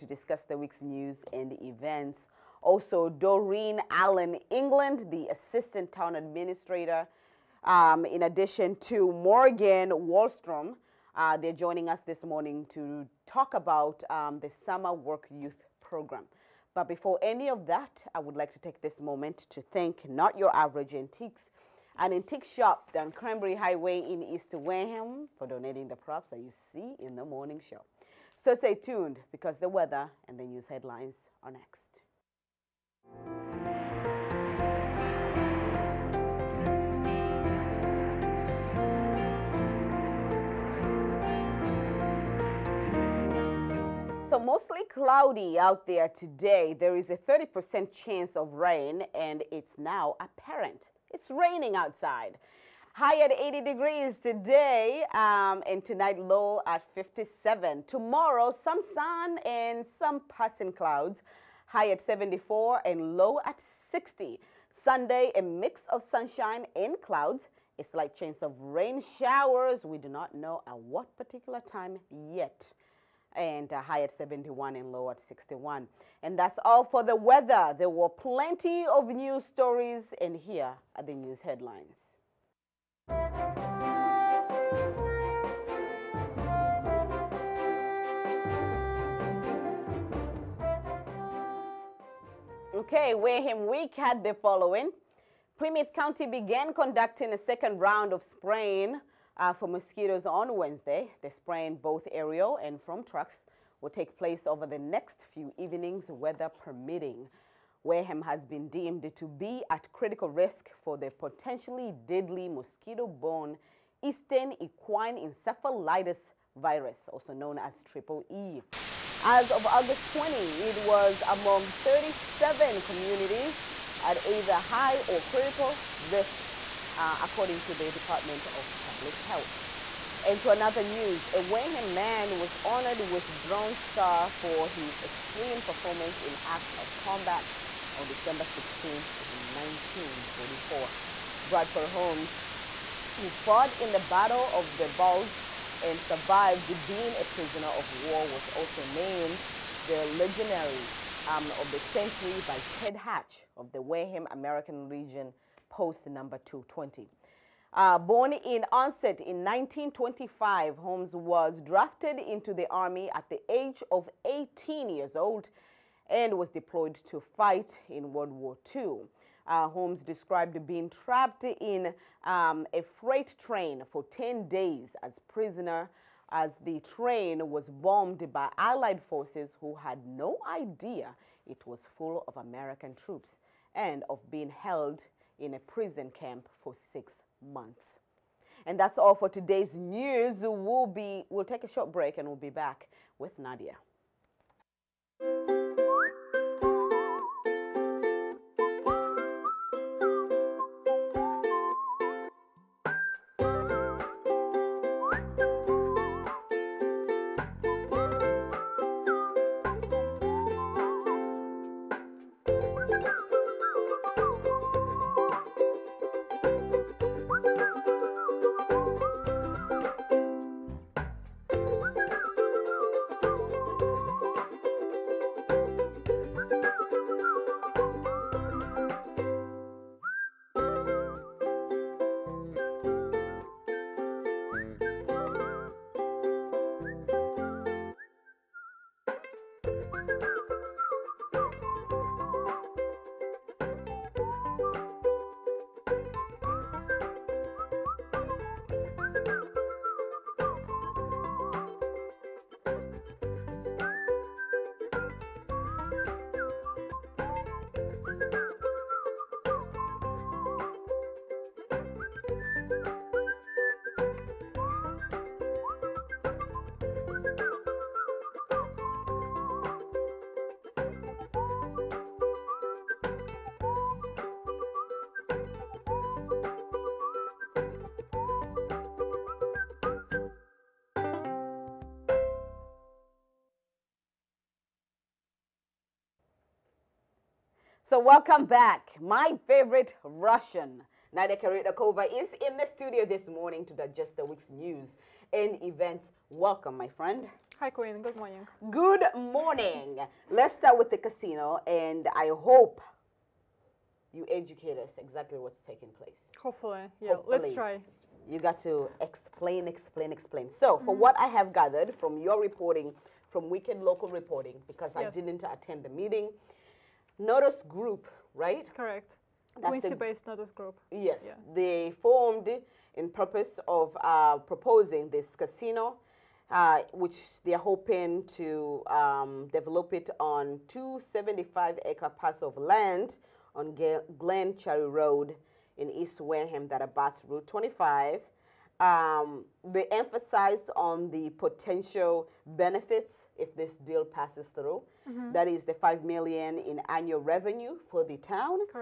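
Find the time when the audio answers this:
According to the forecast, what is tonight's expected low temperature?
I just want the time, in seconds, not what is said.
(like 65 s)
56 s.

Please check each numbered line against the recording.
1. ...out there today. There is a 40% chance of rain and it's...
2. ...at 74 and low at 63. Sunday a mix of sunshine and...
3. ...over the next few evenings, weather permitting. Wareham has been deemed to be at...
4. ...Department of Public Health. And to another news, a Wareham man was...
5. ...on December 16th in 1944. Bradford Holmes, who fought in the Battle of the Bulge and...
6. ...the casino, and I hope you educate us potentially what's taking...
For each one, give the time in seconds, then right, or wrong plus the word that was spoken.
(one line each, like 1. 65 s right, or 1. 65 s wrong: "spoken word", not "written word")
1. 45 s wrong: "30", not "40"
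2. 61 s wrong: "60", not "63"
3. 104 s right
4. 127 s right
5. 137 s right
6. 300 s wrong: "exactly", not "potentially".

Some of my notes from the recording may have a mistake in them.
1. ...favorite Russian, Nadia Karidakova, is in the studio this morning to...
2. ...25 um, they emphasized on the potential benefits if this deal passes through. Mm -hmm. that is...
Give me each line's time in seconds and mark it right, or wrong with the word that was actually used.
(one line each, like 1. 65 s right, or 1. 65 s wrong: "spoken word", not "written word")
1. 289 s right
2. 337 s right.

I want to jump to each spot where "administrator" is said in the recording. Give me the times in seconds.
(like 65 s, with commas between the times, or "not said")
6 s.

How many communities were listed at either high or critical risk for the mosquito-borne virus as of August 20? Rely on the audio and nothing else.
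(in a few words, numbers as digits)
37.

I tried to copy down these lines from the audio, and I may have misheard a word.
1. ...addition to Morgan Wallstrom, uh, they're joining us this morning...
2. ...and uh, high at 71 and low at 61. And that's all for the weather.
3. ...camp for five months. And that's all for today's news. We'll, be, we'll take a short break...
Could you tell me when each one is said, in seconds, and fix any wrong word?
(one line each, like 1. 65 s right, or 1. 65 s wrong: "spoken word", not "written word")
1. 8 s right
2. 73 s right
3. 186 s wrong: "six", not "five".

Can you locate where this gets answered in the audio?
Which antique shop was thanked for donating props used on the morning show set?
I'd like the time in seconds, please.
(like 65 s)
20 s.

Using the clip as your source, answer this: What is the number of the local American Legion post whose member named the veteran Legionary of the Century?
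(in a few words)
220.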